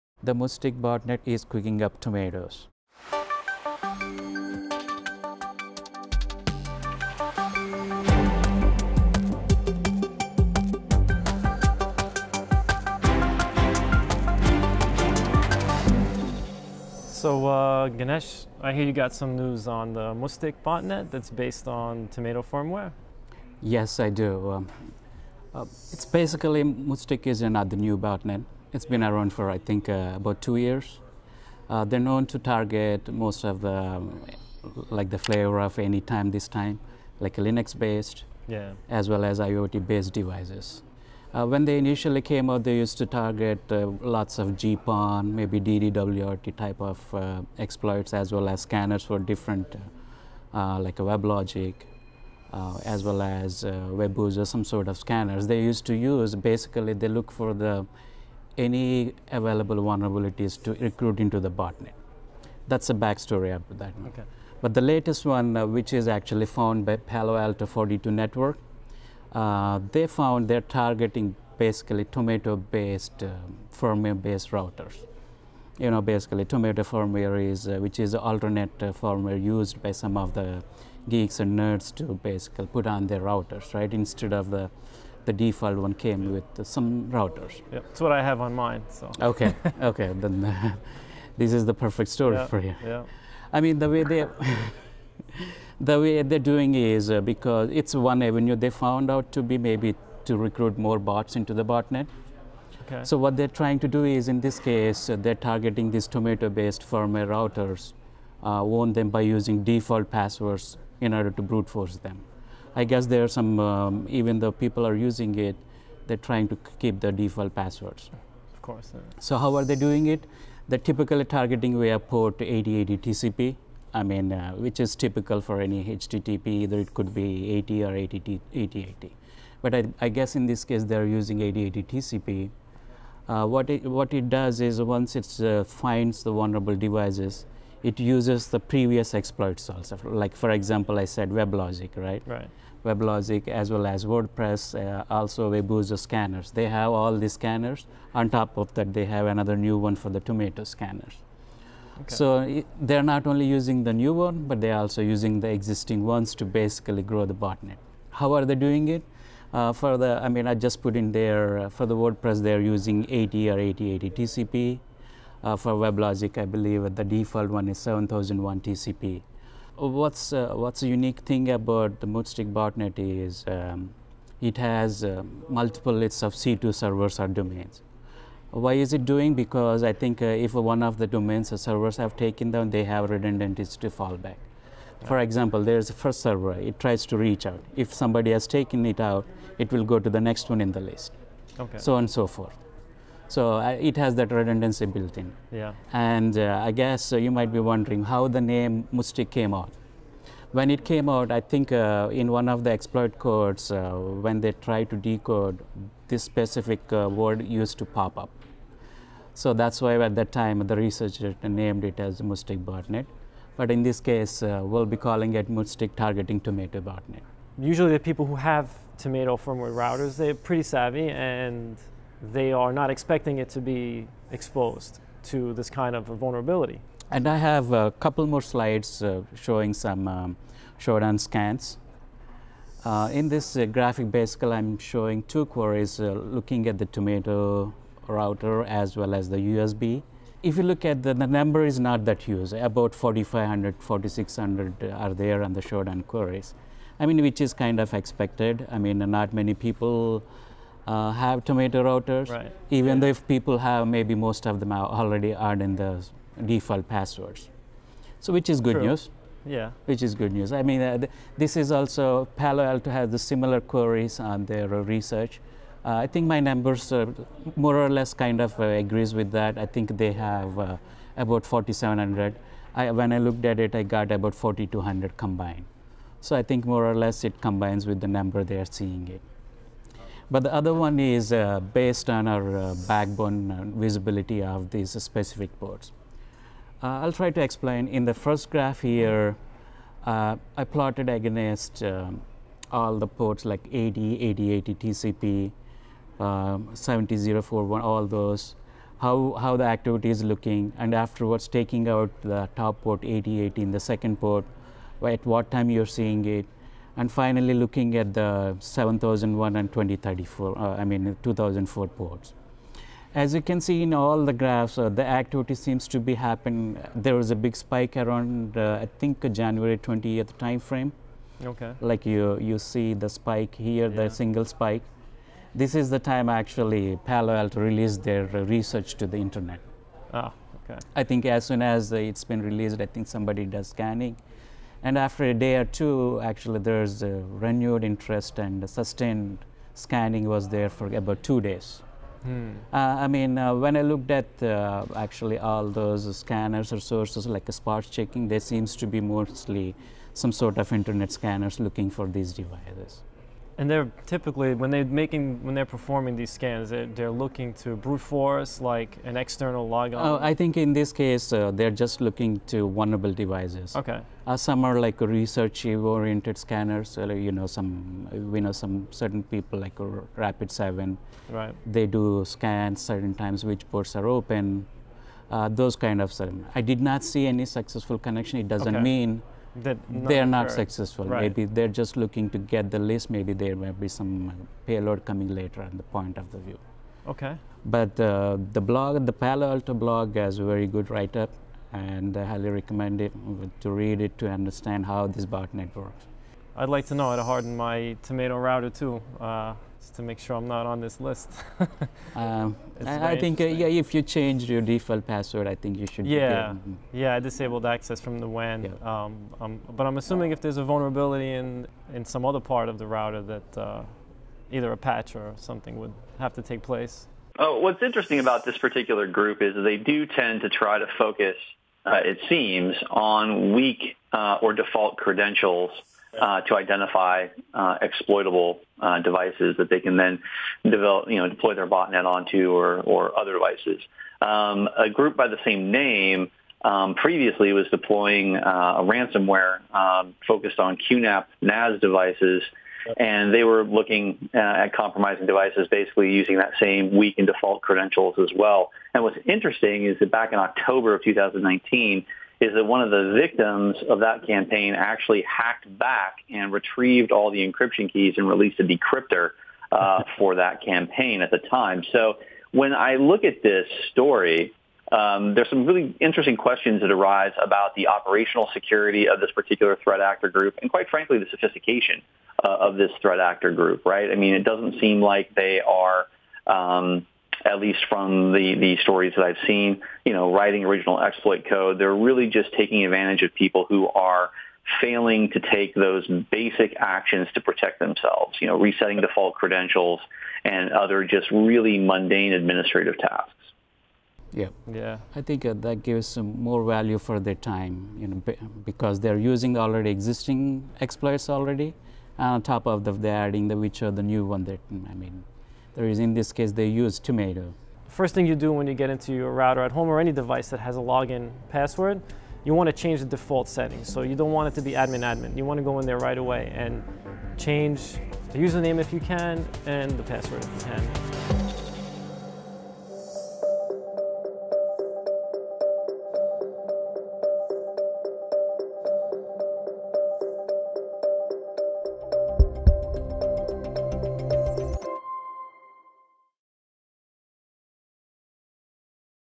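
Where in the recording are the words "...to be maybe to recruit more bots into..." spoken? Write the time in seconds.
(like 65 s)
99 s.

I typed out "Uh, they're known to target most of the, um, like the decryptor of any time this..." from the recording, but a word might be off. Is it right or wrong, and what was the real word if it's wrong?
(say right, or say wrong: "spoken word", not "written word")
wrong: "flavor", not "decryptor".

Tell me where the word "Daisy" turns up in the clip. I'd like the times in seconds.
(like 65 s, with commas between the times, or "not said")
not said.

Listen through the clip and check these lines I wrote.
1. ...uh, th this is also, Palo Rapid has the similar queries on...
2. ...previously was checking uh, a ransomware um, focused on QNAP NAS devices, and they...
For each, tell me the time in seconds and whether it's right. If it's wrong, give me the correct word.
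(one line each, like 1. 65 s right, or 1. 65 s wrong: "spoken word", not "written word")
1. 260 s wrong: "Alto", not "Rapid"
2. 436 s wrong: "deploying", not "checking".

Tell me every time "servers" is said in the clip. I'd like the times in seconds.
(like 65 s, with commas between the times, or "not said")
176 s, 181 s, 186 s.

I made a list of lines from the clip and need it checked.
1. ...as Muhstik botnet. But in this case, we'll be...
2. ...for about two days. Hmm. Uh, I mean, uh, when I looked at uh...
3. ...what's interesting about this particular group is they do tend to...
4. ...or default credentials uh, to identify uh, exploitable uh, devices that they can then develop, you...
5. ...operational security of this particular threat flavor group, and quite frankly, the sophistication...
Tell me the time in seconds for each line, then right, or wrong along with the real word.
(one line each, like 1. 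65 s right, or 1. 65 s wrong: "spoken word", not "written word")
1. 212 s right
2. 340 s right
3. 417 s right
4. 424 s right
5. 467 s wrong: "actor", not "flavor".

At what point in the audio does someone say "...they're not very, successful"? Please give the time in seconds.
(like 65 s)
379 s.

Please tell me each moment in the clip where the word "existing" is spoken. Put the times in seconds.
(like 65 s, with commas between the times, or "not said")
155 s, 499 s.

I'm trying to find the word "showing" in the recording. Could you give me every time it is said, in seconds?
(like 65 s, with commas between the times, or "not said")
229 s, 234 s.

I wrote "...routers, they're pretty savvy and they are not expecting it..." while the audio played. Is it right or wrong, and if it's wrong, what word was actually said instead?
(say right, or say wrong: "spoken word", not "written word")
right.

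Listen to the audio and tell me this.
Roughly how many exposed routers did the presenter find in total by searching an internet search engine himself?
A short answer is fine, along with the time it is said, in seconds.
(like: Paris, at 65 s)
4,200, at 274 s.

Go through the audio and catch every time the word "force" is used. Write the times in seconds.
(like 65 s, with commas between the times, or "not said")
111 s, 358 s.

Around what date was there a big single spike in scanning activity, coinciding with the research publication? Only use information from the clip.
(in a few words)
January 20th.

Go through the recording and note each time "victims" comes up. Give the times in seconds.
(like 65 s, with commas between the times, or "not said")
453 s.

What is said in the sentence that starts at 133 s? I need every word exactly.
Uh, what, it, what it does is once it uh, finds the vulnerable devices, it uses the previous exploits also.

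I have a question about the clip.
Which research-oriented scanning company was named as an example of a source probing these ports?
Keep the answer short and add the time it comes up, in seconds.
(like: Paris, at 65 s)
Rapid Seven, at 370 s.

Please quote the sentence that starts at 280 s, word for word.
But the other one is uh, based on our uh, backbone uh, visibility of these specific ports.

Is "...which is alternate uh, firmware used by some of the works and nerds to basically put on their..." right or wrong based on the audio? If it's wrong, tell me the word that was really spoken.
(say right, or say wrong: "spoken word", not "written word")
wrong: "geeks", not "works".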